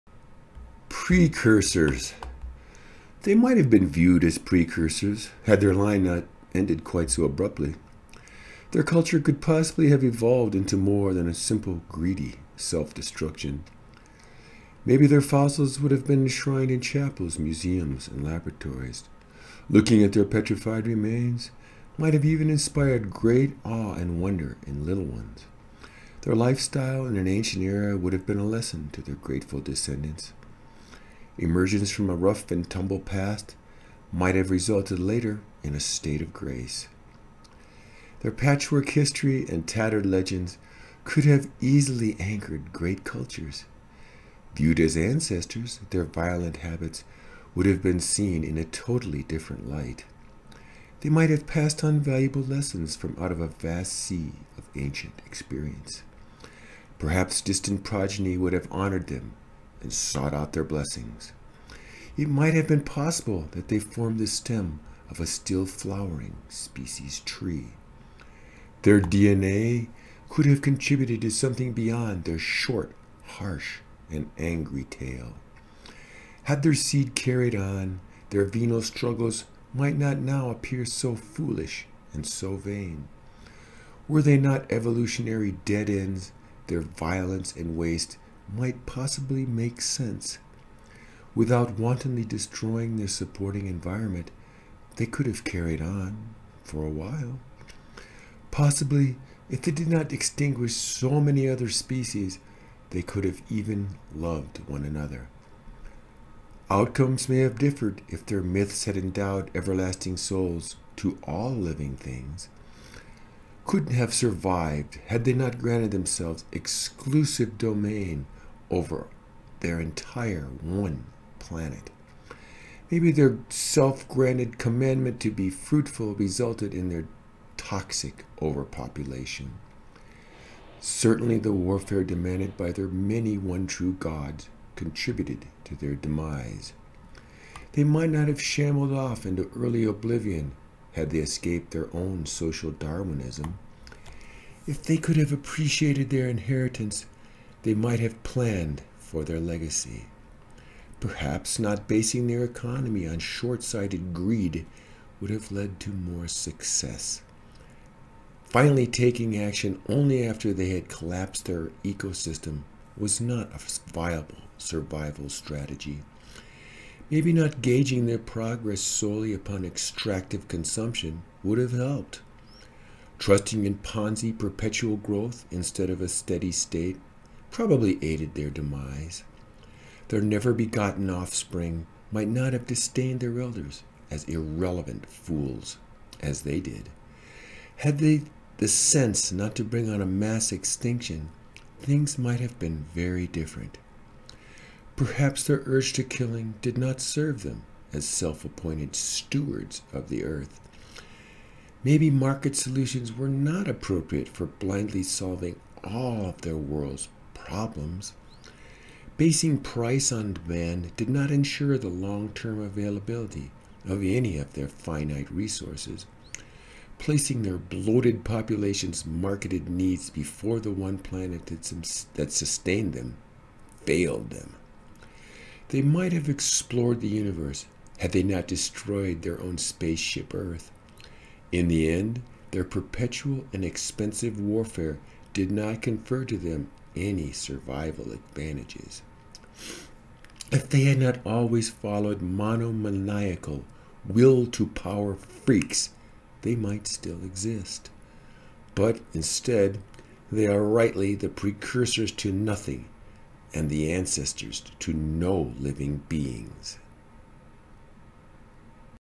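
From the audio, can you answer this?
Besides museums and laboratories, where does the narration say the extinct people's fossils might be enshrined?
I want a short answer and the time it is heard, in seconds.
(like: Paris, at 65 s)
Chapels, at 16 s.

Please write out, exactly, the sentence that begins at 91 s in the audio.
Without wantonly destroying their supporting environment, they could have carried on for a while.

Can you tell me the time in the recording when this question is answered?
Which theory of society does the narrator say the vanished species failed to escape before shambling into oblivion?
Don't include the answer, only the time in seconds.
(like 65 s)
142 s.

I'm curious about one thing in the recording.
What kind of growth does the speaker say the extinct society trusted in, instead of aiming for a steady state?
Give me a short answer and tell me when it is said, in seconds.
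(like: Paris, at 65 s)
Ponzi perpetual growth, at 173 s.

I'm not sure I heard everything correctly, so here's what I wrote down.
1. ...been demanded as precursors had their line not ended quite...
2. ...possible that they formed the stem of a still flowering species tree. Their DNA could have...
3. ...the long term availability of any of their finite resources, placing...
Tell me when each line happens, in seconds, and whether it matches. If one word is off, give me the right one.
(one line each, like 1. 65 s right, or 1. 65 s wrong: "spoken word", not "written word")
1. 3 s wrong: "viewed", not "demanded"
2. 62 s right
3. 211 s right.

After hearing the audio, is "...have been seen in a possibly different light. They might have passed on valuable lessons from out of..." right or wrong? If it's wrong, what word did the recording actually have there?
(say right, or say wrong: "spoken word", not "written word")
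wrong: "totally", not "possibly".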